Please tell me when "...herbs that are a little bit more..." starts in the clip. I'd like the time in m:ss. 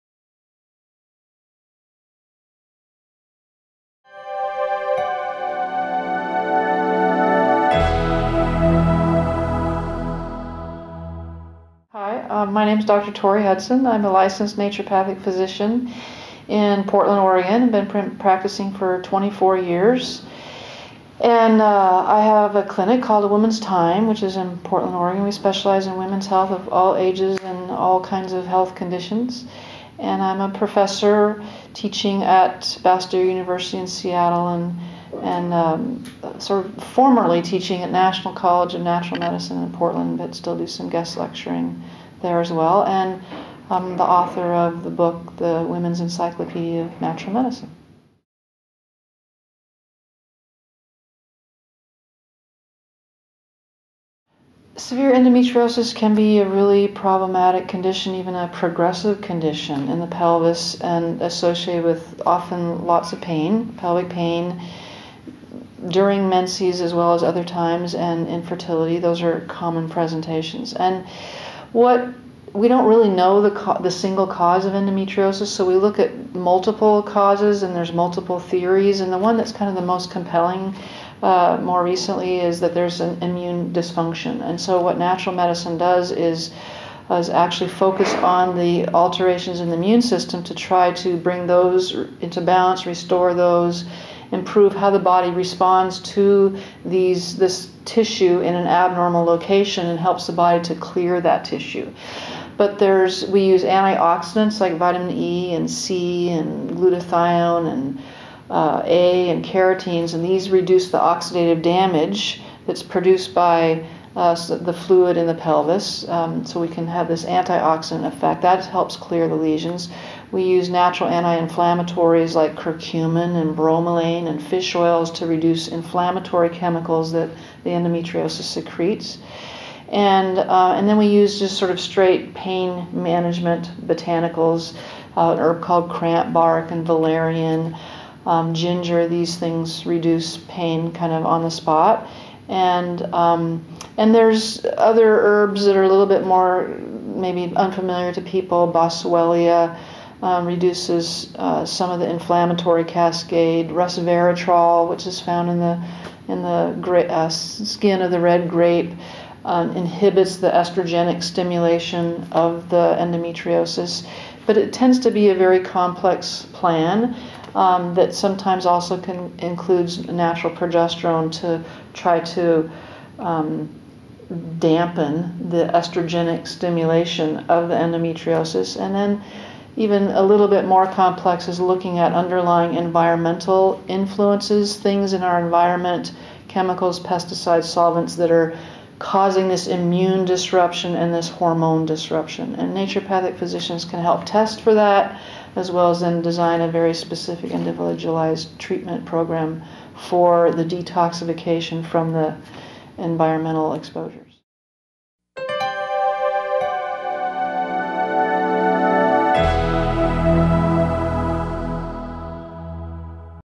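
2:25.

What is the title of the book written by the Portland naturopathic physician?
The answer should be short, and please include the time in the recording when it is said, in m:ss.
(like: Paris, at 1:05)
The Women's Encyclopedia of Natural Medicine, at 0:45.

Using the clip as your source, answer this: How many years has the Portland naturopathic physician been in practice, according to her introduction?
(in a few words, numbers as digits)
24.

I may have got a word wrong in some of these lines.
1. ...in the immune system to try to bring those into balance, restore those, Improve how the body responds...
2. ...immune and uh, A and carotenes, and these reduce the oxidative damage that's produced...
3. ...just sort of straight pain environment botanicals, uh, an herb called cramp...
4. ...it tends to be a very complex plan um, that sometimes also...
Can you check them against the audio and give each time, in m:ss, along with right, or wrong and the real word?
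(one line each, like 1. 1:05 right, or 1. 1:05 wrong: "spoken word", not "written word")
1. 1:29 right
2. 1:46 wrong: "glutathione", not "immune"
3. 2:11 wrong: "management", not "environment"
4. 2:44 right.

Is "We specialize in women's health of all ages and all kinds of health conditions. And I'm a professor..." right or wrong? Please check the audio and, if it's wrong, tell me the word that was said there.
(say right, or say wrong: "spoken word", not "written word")
right.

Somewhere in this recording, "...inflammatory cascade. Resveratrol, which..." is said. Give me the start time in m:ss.
2:32.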